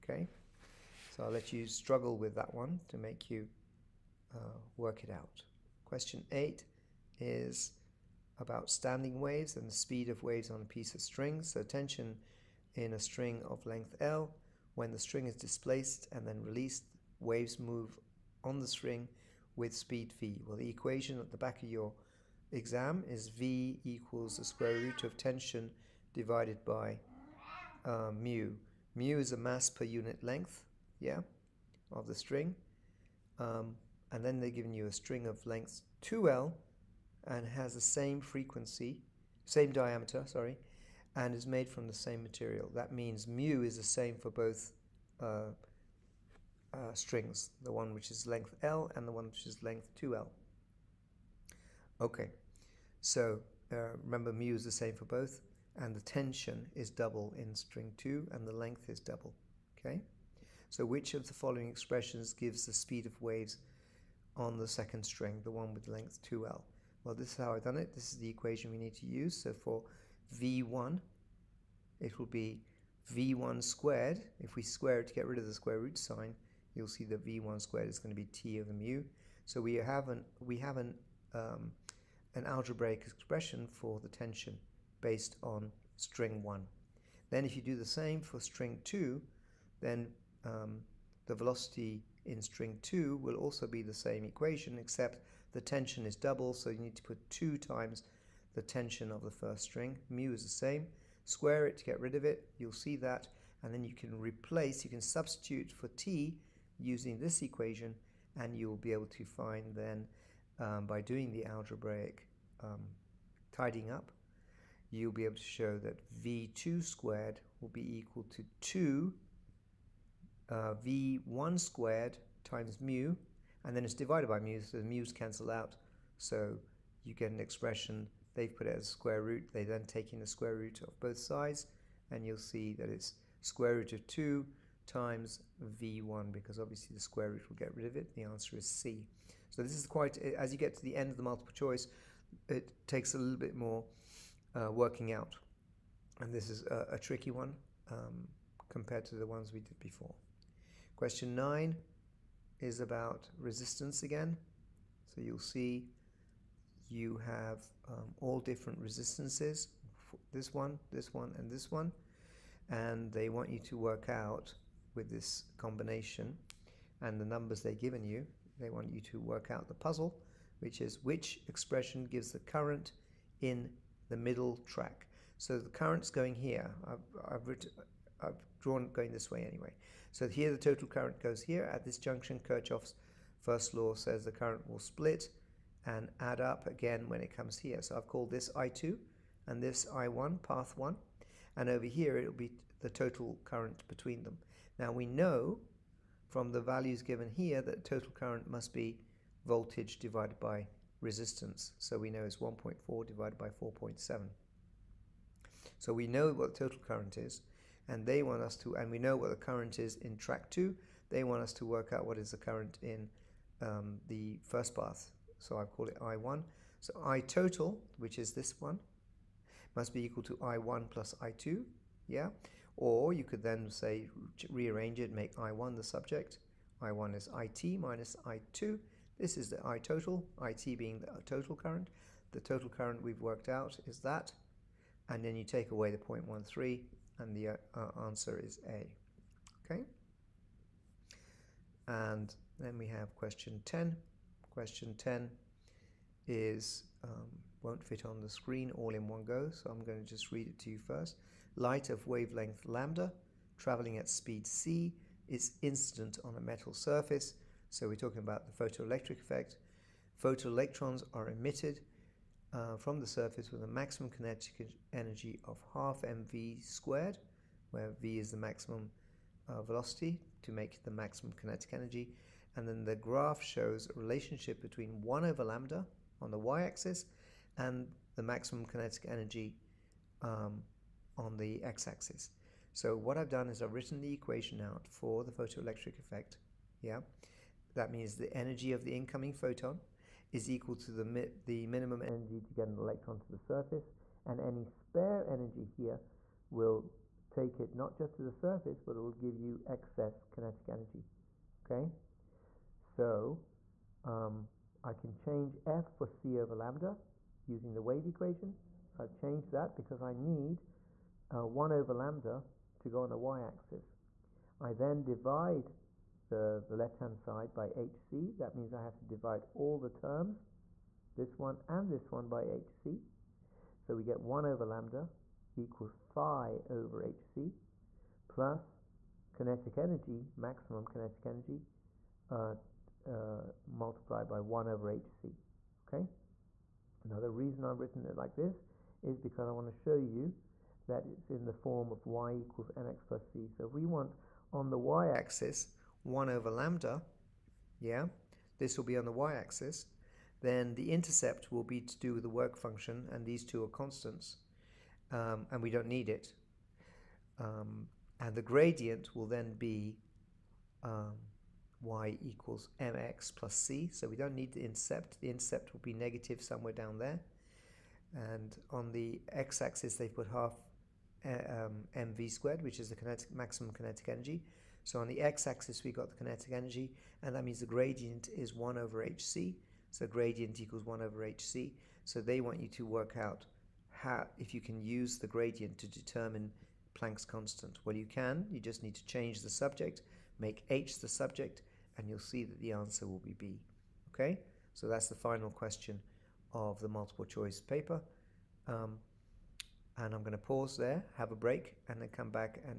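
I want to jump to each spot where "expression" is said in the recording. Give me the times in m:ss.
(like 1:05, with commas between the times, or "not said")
1:01, 1:23, 2:07, 2:51.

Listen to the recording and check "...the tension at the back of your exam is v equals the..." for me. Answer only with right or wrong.
wrong.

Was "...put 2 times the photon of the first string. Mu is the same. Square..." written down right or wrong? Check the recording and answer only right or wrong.
wrong.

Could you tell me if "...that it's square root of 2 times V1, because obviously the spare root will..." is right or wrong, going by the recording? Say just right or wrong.
wrong.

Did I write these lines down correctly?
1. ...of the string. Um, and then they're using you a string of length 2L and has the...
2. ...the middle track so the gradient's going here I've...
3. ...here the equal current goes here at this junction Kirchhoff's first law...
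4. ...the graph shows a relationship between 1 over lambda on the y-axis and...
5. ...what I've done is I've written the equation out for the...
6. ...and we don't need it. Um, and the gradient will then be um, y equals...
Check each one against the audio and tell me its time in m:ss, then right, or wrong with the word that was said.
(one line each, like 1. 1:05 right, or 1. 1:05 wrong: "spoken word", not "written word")
1. 0:31 wrong: "giving", not "using"
2. 2:54 wrong: "current", not "gradient"
3. 3:00 wrong: "total", not "equal"
4. 4:32 right
5. 4:42 right
6. 5:55 right.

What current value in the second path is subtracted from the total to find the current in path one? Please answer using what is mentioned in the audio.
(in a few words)
0.13.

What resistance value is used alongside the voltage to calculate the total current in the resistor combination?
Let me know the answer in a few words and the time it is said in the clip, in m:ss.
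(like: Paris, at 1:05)
4.7, at 3:23.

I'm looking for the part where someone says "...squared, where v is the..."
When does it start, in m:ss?
4:26.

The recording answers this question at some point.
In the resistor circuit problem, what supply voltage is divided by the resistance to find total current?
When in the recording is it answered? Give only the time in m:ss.
3:22.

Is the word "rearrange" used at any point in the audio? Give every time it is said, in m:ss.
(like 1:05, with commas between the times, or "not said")
3:44.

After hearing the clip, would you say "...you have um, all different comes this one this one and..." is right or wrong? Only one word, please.
wrong.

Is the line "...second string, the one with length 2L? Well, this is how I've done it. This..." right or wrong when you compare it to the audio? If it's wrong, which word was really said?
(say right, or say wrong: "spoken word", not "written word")
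right.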